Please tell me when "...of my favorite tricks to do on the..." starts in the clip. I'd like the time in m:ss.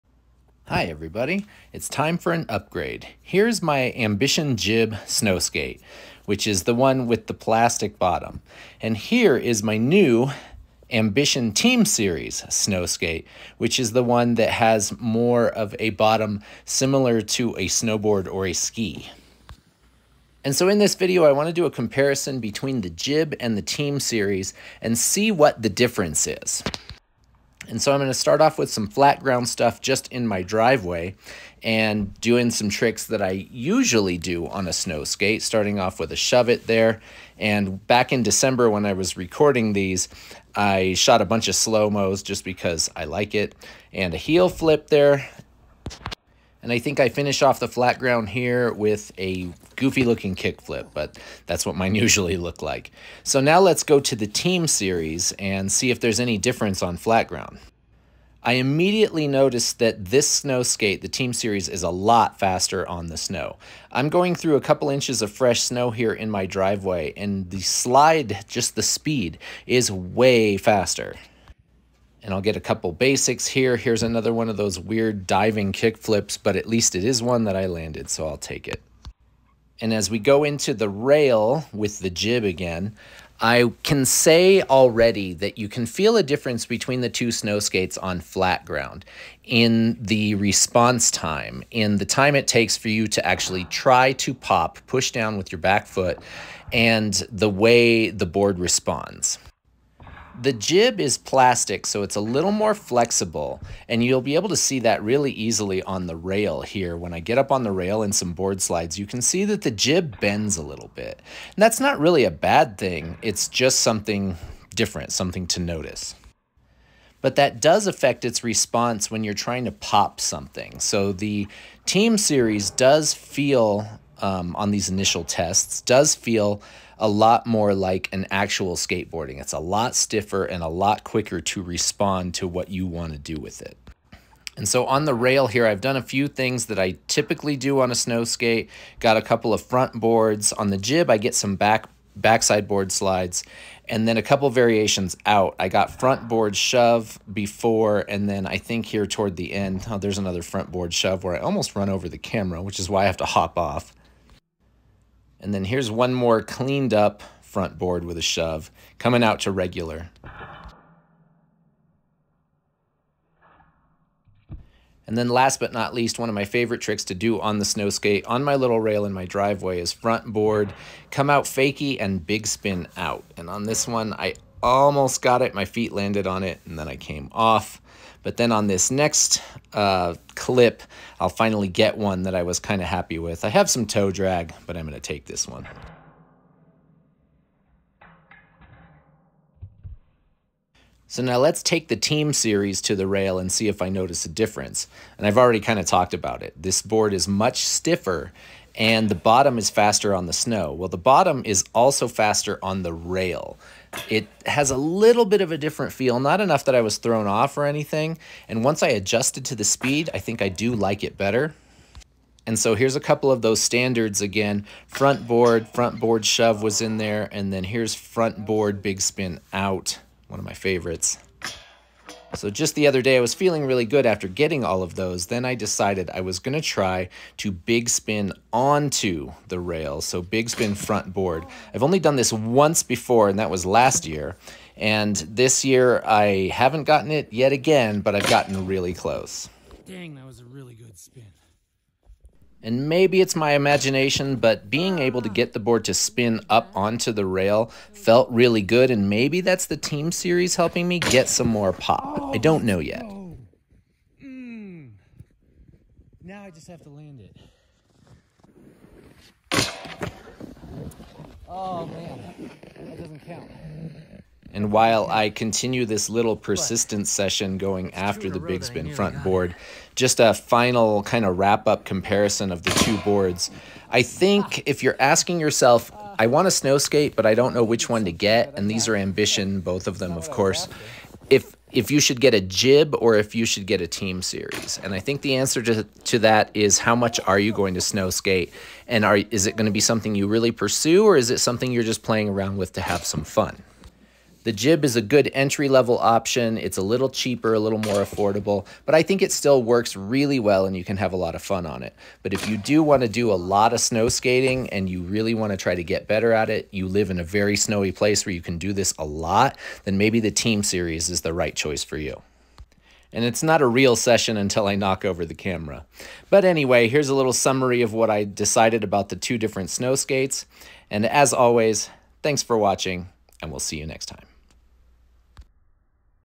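2:46.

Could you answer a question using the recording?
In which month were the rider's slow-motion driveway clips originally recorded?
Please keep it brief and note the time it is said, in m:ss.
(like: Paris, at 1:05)
December, at 0:38.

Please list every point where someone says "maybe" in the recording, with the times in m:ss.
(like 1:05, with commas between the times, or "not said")
4:02, 4:09, 5:09.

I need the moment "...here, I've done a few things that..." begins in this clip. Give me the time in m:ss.
2:15.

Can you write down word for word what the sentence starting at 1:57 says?
But that does affect its response when you're trying to pop something.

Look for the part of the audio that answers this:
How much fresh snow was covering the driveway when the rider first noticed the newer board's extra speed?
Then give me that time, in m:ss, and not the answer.
1:04.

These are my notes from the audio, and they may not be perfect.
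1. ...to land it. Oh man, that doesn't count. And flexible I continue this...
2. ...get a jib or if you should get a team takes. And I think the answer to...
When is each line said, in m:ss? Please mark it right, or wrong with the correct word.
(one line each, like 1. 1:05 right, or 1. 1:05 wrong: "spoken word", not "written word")
1. 4:16 wrong: "while", not "flexible"
2. 4:42 wrong: "series", not "takes".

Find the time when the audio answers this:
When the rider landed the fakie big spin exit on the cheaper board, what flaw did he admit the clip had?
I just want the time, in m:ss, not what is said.
3:03.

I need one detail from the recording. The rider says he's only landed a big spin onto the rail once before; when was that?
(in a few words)
Last year.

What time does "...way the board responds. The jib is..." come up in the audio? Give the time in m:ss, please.
1:37.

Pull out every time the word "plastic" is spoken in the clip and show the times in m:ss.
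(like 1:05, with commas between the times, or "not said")
0:07, 1:41.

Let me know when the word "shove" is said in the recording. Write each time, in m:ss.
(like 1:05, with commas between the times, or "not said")
0:36, 2:26, 2:30, 2:38, 3:36.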